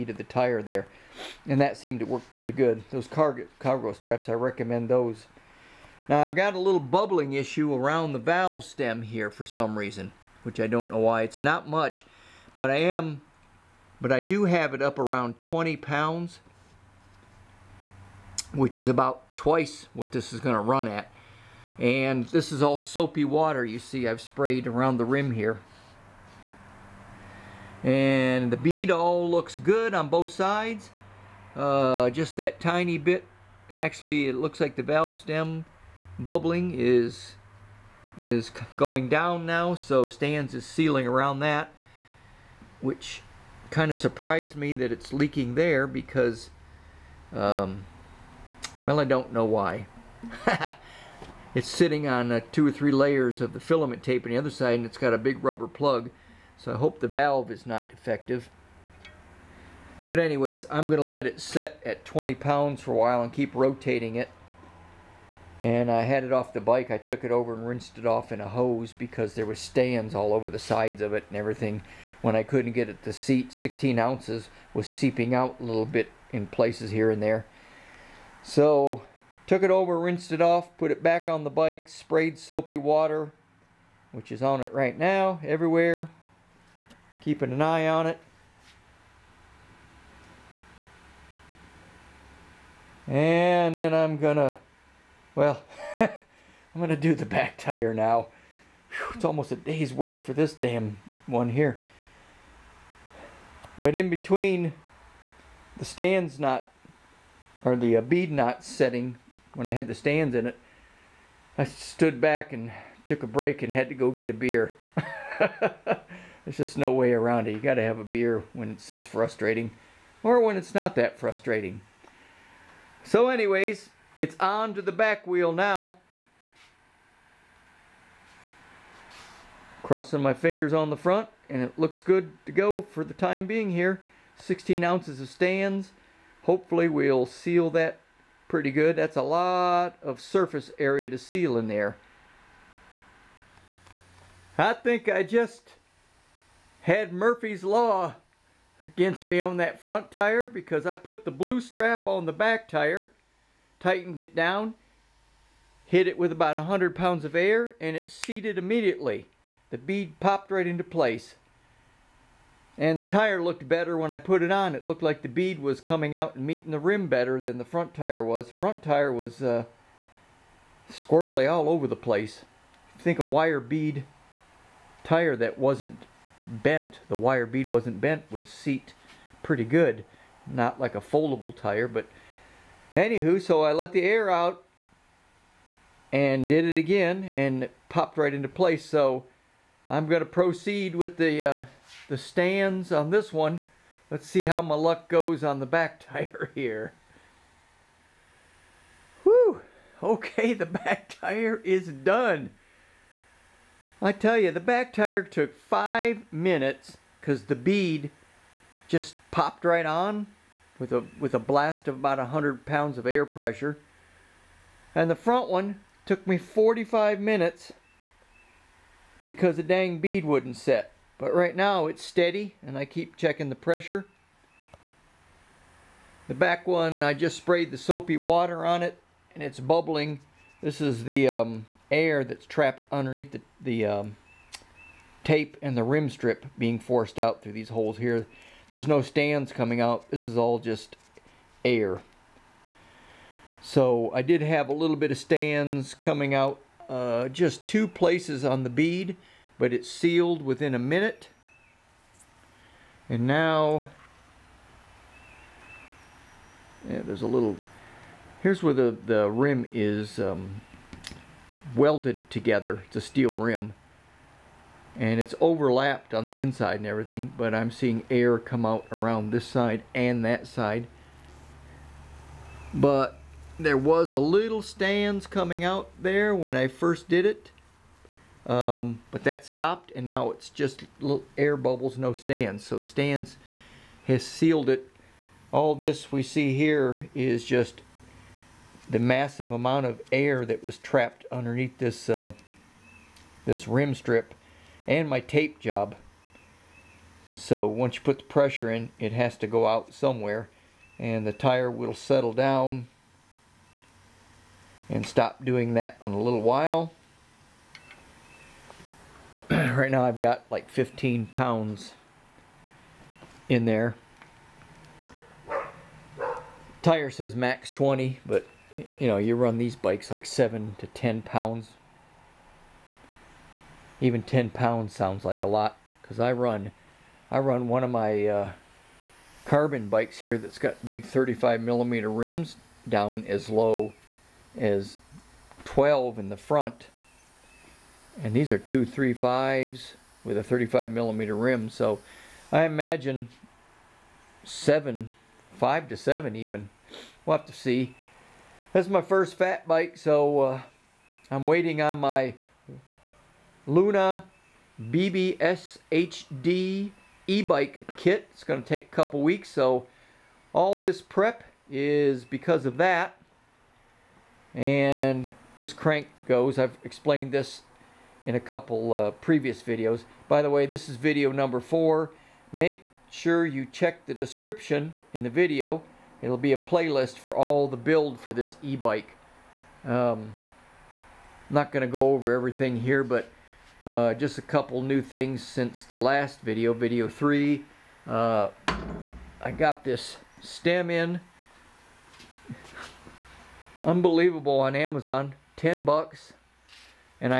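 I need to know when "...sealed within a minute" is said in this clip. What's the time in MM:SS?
04:09.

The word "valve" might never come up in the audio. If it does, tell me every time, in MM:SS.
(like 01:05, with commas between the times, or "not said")
00:08, 00:34, 00:57.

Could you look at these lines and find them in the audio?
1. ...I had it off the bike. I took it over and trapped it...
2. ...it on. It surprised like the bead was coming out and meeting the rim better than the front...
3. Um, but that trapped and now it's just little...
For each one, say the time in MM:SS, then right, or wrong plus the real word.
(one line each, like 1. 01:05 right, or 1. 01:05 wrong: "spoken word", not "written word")
1. 01:05 wrong: "rinsed", not "trapped"
2. 02:44 wrong: "looked", not "surprised"
3. 04:38 wrong: "stopped", not "trapped".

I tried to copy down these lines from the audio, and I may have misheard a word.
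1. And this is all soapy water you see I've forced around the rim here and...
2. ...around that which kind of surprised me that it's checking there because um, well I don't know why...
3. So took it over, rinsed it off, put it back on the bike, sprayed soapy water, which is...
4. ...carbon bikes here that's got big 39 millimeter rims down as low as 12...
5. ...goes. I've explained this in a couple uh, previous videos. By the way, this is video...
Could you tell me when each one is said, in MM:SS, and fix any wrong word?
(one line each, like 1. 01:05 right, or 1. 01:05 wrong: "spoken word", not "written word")
1. 00:21 wrong: "sprayed", not "forced"
2. 00:41 wrong: "leaking", not "checking"
3. 01:18 right
4. 05:29 wrong: "35", not "39"
5. 06:06 right.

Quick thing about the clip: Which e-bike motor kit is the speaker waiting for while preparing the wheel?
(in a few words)
Luna BBSHD.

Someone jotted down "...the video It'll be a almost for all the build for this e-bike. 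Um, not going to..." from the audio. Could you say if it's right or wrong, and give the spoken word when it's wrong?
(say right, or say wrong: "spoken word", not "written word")
wrong: "playlist", not "almost".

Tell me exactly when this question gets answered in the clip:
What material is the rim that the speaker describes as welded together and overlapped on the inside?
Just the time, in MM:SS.
04:23.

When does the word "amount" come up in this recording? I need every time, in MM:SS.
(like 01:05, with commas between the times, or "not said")
04:49.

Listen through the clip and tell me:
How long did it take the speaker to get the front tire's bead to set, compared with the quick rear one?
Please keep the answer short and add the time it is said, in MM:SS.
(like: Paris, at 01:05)
45 minutes, at 03:36.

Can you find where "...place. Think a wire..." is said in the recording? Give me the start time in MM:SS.
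02:51.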